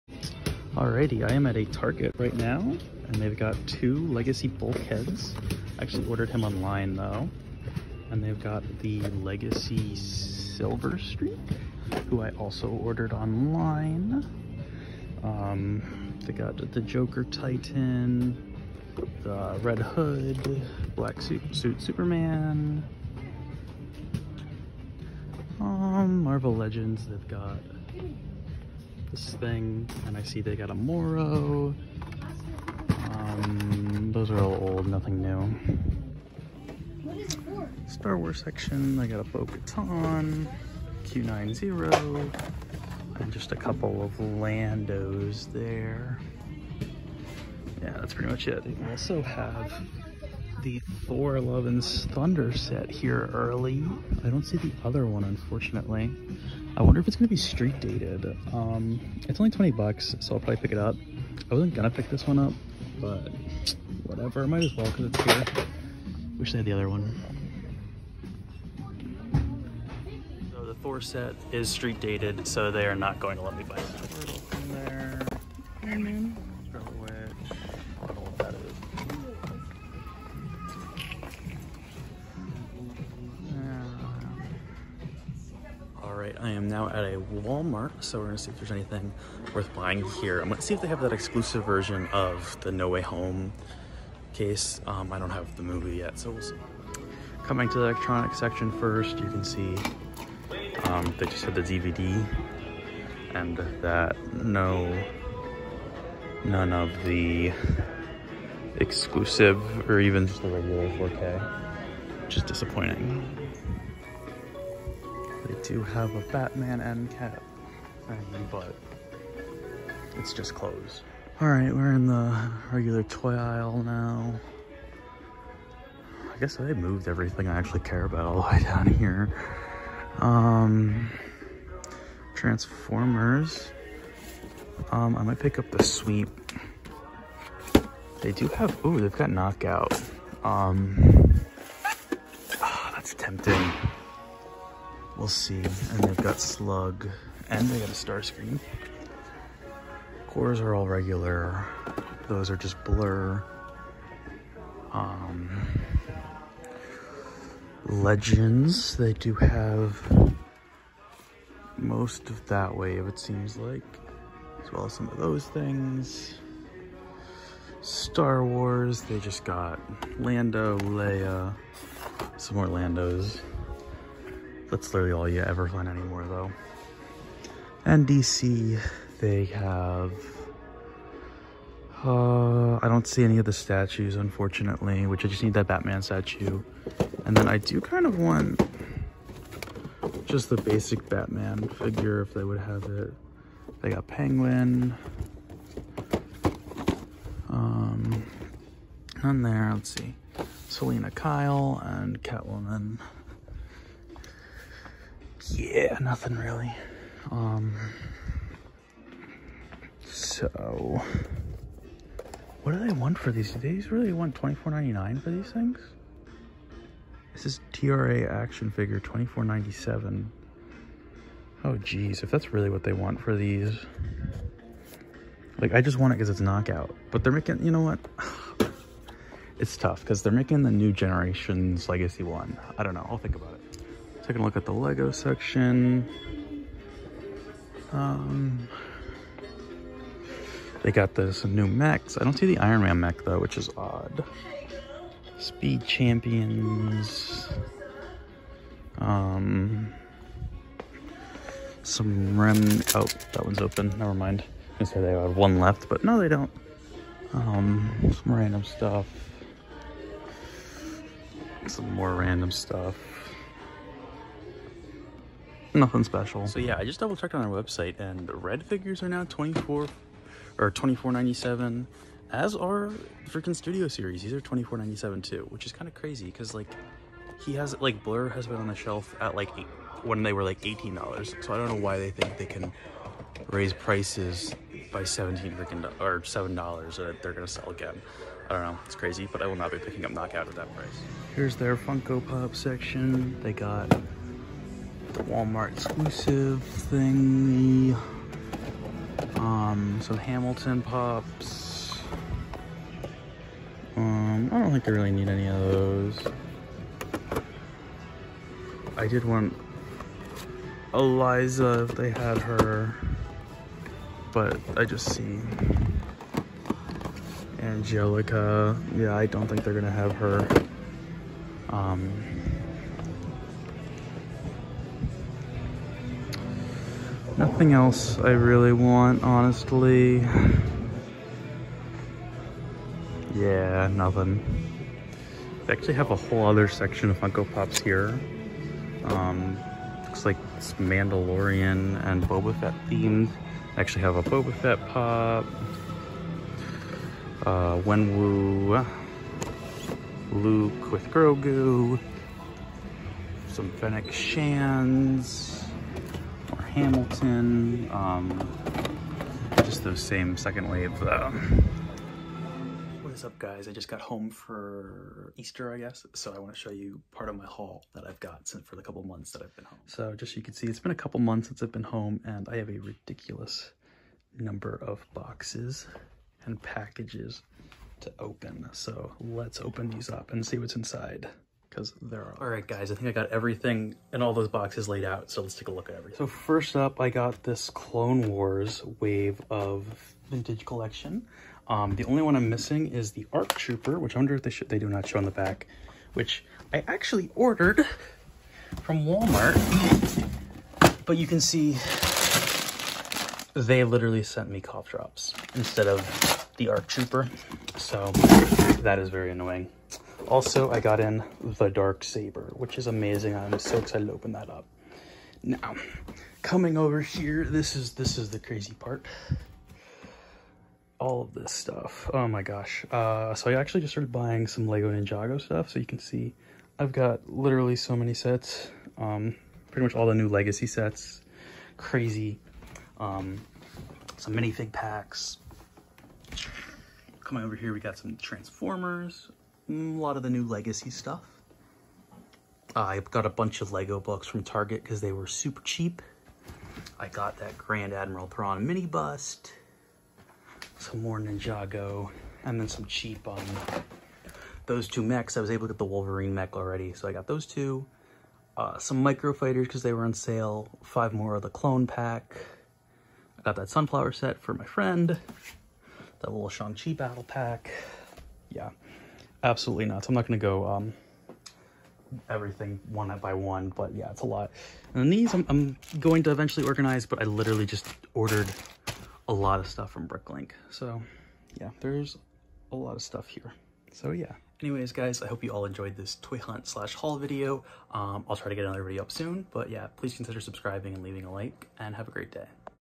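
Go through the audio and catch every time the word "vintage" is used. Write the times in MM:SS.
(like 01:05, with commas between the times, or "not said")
06:30.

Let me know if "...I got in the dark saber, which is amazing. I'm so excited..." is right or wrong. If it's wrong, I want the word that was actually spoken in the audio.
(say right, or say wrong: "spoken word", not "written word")
right.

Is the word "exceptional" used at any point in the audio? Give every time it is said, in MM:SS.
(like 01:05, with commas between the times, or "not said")
not said.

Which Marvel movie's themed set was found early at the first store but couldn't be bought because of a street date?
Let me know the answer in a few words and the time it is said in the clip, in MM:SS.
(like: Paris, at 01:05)
Thor Love and Thunder, at 00:51.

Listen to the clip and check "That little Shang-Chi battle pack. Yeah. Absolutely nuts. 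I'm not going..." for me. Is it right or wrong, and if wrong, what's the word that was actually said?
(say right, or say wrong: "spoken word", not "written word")
right.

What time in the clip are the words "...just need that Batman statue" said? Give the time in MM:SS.
03:05.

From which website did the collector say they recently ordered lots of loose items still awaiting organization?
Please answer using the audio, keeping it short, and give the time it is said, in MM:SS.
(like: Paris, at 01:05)
Bricklink, at 08:00.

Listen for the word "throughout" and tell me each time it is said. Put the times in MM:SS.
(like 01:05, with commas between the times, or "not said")
not said.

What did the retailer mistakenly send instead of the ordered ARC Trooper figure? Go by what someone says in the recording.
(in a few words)
Cough drops.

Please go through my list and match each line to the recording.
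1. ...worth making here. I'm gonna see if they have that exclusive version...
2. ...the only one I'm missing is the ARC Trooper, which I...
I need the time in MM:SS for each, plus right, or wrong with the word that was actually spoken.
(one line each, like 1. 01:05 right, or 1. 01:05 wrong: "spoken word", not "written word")
1. 01:29 wrong: "buying", not "making"
2. 06:31 right.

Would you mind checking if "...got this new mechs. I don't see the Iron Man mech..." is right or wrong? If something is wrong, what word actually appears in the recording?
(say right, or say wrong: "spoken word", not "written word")
right.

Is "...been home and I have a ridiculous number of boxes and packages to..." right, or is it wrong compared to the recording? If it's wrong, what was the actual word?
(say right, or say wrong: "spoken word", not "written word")
right.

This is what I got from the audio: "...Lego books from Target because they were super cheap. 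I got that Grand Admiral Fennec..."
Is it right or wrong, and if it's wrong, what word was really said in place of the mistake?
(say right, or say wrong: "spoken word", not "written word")
wrong: "Thrawn", not "Fennec".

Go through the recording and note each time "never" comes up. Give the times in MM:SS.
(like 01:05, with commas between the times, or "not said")
04:13.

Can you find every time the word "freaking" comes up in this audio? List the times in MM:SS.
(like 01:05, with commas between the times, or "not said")
04:33, 04:45.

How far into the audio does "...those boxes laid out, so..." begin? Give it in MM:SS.
06:24.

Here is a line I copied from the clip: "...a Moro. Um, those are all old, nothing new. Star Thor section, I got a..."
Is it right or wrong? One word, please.
wrong.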